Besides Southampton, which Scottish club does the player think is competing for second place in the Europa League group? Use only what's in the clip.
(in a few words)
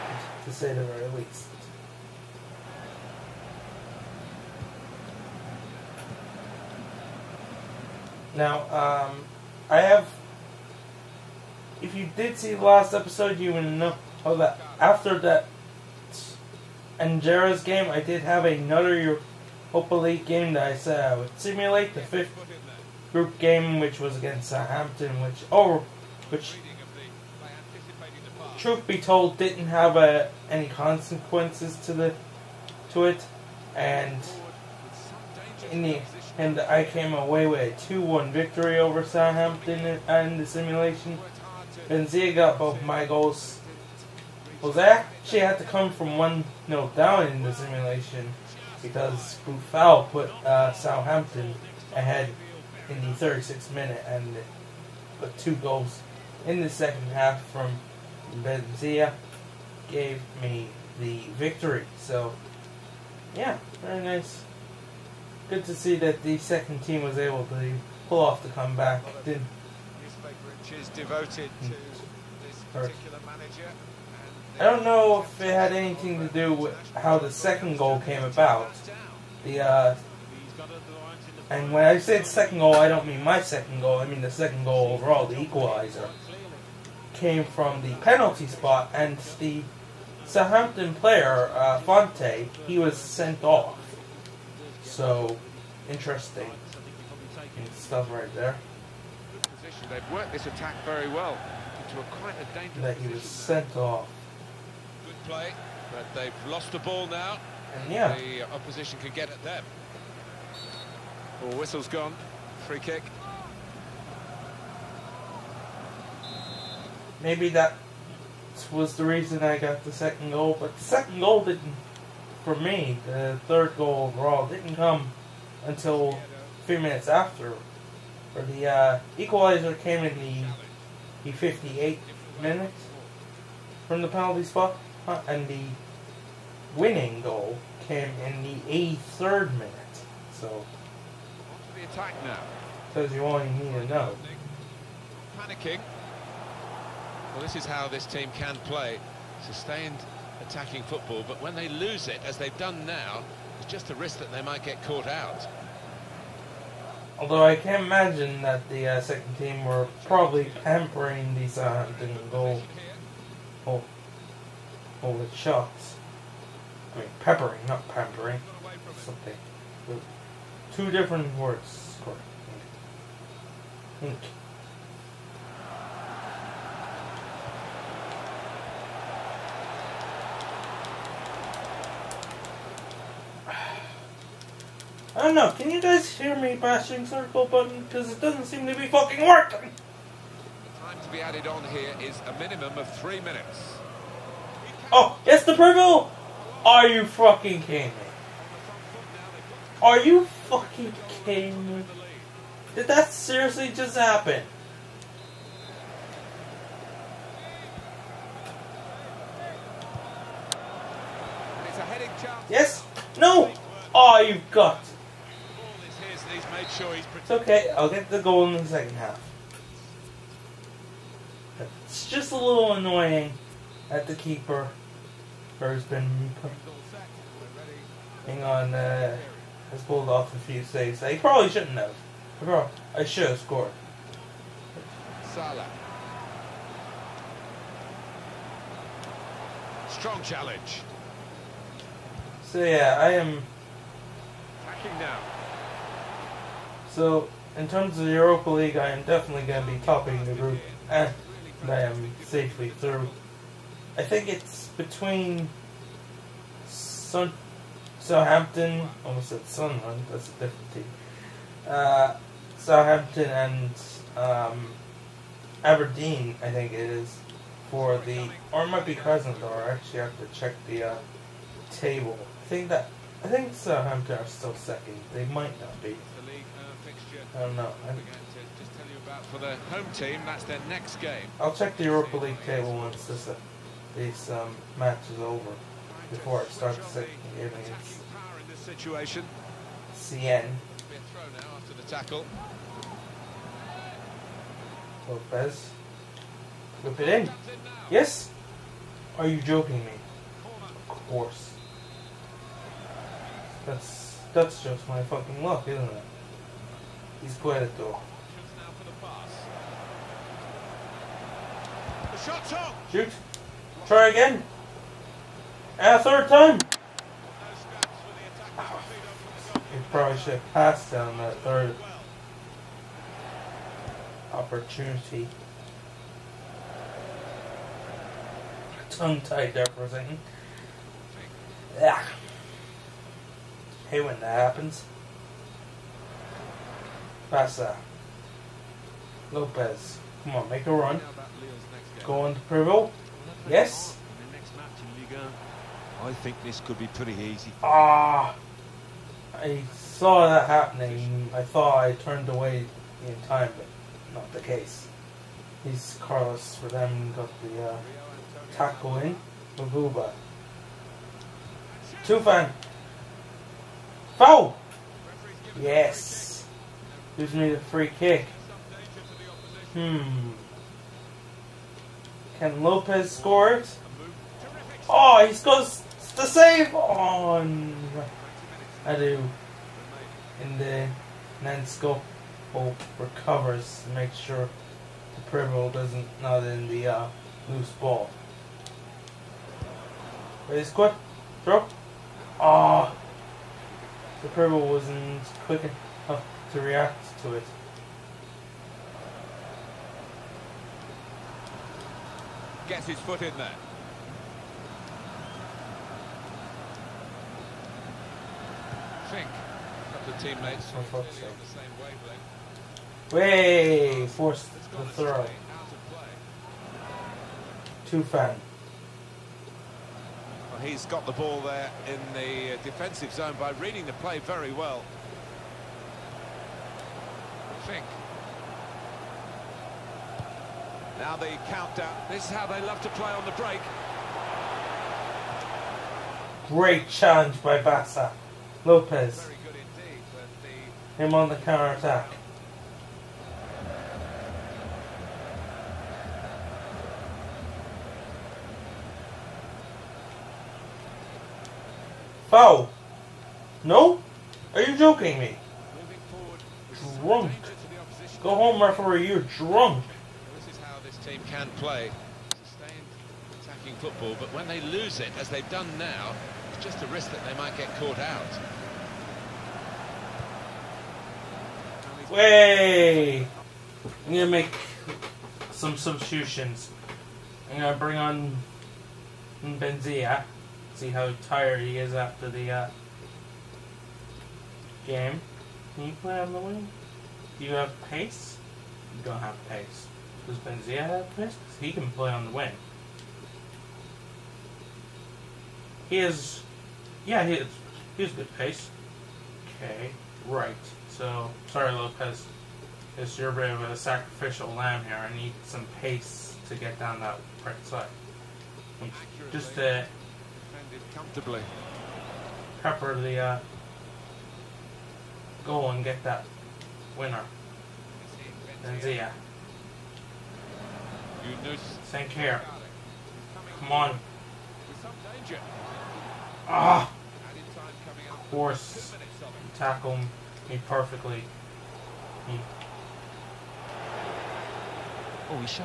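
Aberdeen.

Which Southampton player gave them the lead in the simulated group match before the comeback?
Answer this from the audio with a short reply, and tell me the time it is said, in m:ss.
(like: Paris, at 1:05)
Boufal, at 0:49.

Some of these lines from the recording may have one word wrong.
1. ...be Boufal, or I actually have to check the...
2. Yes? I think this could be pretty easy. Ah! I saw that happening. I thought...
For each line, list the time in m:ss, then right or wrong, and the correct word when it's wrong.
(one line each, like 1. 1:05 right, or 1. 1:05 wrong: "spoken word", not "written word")
1. 4:28 wrong: "Crescent", not "Boufal"
2. 5:43 right.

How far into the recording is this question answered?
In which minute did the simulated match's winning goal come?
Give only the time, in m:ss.
2:19.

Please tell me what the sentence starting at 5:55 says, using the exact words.
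He's Carlos for them got the uh, tackle in Too Tufan!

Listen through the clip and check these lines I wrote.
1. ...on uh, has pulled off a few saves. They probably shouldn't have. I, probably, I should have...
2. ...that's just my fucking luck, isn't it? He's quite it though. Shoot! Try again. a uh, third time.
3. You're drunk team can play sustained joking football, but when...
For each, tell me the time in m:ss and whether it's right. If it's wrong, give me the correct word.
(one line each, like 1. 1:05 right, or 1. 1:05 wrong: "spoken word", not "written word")
1. 3:48 right
2. 5:04 right
3. 7:39 wrong: "attacking", not "joking".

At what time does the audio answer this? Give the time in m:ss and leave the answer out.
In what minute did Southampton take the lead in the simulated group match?
0:53.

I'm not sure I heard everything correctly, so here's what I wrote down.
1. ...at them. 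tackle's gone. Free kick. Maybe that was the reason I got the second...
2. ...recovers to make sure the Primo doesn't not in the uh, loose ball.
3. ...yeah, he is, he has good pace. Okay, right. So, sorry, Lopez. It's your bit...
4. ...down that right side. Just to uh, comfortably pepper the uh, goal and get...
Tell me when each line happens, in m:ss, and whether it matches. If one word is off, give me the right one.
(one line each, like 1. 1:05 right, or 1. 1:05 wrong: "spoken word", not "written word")
1. 1:49 wrong: "whistle", not "tackle"
2. 6:22 right
3. 8:17 right
4. 8:26 right.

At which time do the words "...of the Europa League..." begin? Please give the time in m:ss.
4:07.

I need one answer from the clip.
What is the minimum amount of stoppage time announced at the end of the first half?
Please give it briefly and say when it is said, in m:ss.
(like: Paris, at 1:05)
3 minutes, at 3:12.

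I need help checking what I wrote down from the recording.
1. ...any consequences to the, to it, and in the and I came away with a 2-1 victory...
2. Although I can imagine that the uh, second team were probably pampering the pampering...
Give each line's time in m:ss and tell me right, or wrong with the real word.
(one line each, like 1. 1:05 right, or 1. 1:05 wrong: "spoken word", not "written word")
1. 0:30 right
2. 2:37 wrong: "hunting", not "pampering".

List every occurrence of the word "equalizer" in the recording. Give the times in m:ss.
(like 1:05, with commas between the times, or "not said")
1:25, 2:09.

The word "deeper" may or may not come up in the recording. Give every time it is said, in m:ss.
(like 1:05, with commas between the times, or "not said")
not said.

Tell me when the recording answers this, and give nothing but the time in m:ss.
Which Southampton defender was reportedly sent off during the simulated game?
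1:31.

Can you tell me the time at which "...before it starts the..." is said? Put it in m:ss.
4:46.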